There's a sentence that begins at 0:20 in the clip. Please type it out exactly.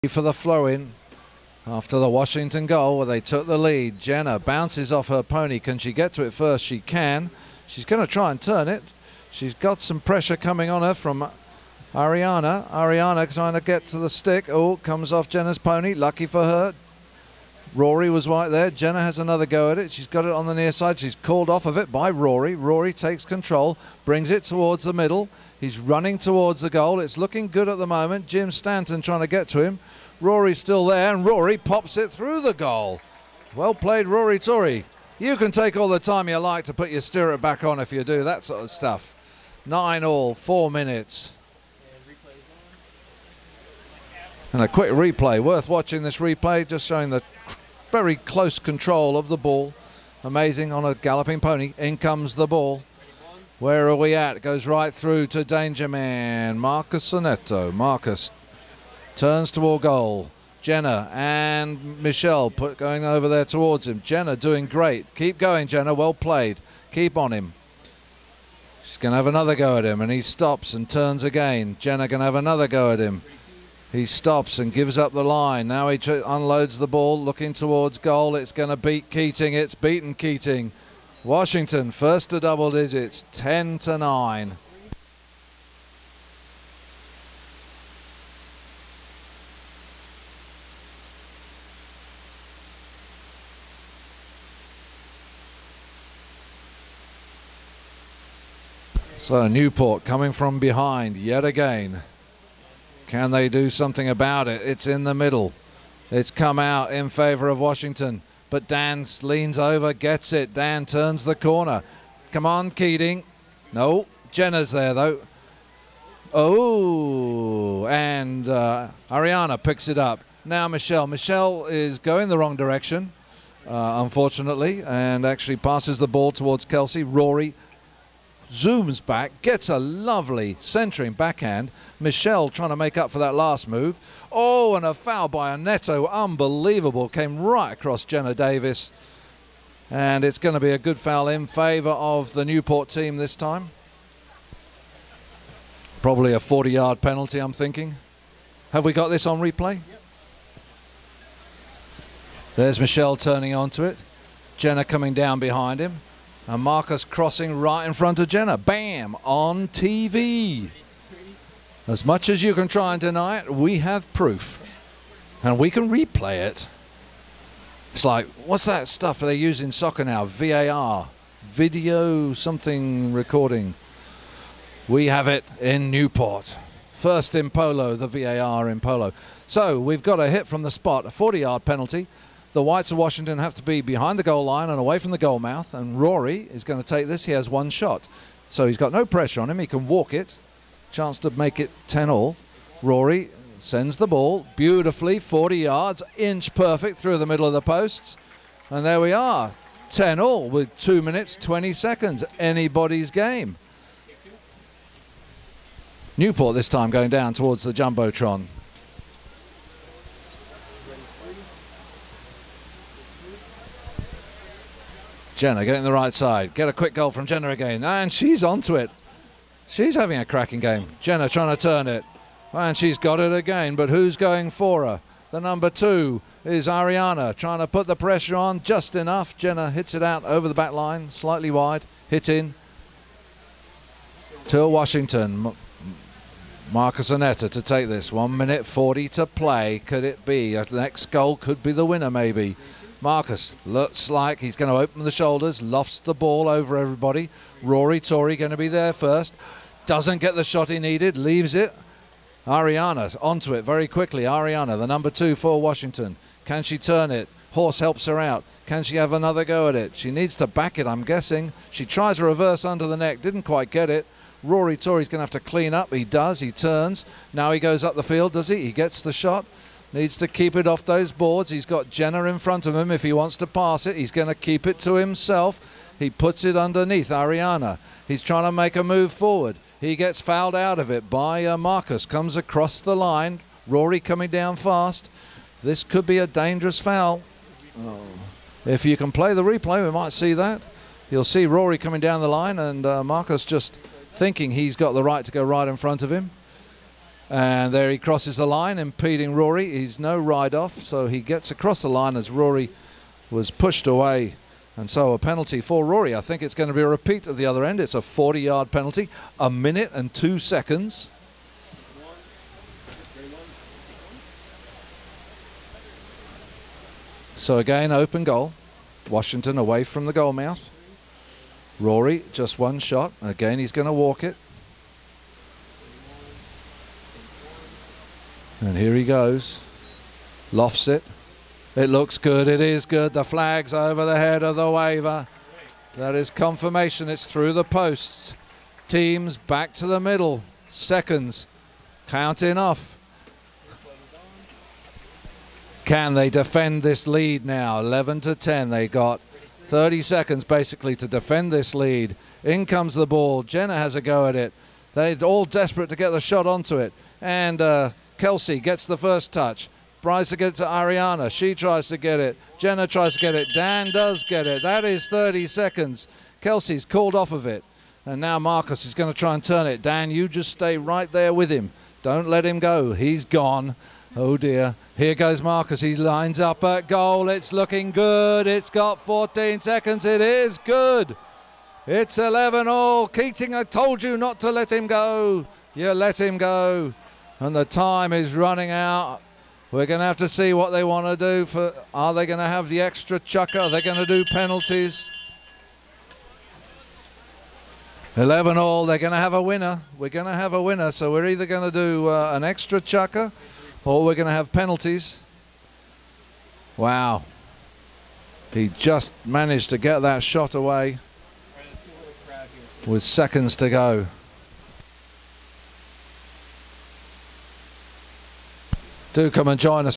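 She's called off of it by Rory.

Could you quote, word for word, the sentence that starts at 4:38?
He's trying to make a move forward.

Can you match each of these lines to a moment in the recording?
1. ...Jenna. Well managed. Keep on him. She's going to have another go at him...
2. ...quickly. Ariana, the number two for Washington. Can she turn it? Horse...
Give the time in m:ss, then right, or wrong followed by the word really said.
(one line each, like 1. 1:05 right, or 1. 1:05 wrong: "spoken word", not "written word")
1. 1:05 wrong: "played", not "managed"
2. 4:13 right.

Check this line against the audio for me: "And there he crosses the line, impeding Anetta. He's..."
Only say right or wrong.
wrong.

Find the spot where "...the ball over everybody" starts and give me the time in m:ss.
4:05.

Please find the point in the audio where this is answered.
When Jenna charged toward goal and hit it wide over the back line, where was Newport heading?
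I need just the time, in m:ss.
3:27.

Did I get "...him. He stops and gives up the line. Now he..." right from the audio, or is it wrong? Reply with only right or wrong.
right.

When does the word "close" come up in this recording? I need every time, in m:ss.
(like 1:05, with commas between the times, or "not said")
0:48.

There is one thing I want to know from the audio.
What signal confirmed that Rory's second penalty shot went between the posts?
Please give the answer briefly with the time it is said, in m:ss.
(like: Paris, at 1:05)
The flag over the head, at 5:33.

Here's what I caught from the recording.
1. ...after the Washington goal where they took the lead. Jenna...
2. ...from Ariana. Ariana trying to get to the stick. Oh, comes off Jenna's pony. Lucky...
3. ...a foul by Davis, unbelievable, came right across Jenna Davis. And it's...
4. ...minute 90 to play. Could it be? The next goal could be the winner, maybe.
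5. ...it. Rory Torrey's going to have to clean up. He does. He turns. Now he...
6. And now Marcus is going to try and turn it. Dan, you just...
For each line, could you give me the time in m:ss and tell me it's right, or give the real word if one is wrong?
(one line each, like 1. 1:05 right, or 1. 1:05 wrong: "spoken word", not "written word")
1. 0:01 right
2. 0:10 right
3. 2:14 wrong: "Aneto", not "Davis"
4. 3:58 wrong: "40", not "90"
5. 4:23 right
6. 6:08 right.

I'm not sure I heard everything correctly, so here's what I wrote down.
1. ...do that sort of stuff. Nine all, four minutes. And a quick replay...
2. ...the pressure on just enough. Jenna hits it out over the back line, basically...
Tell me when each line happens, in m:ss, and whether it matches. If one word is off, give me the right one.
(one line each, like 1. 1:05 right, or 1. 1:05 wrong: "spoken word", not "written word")
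1. 0:38 right
2. 3:47 wrong: "slightly", not "basically".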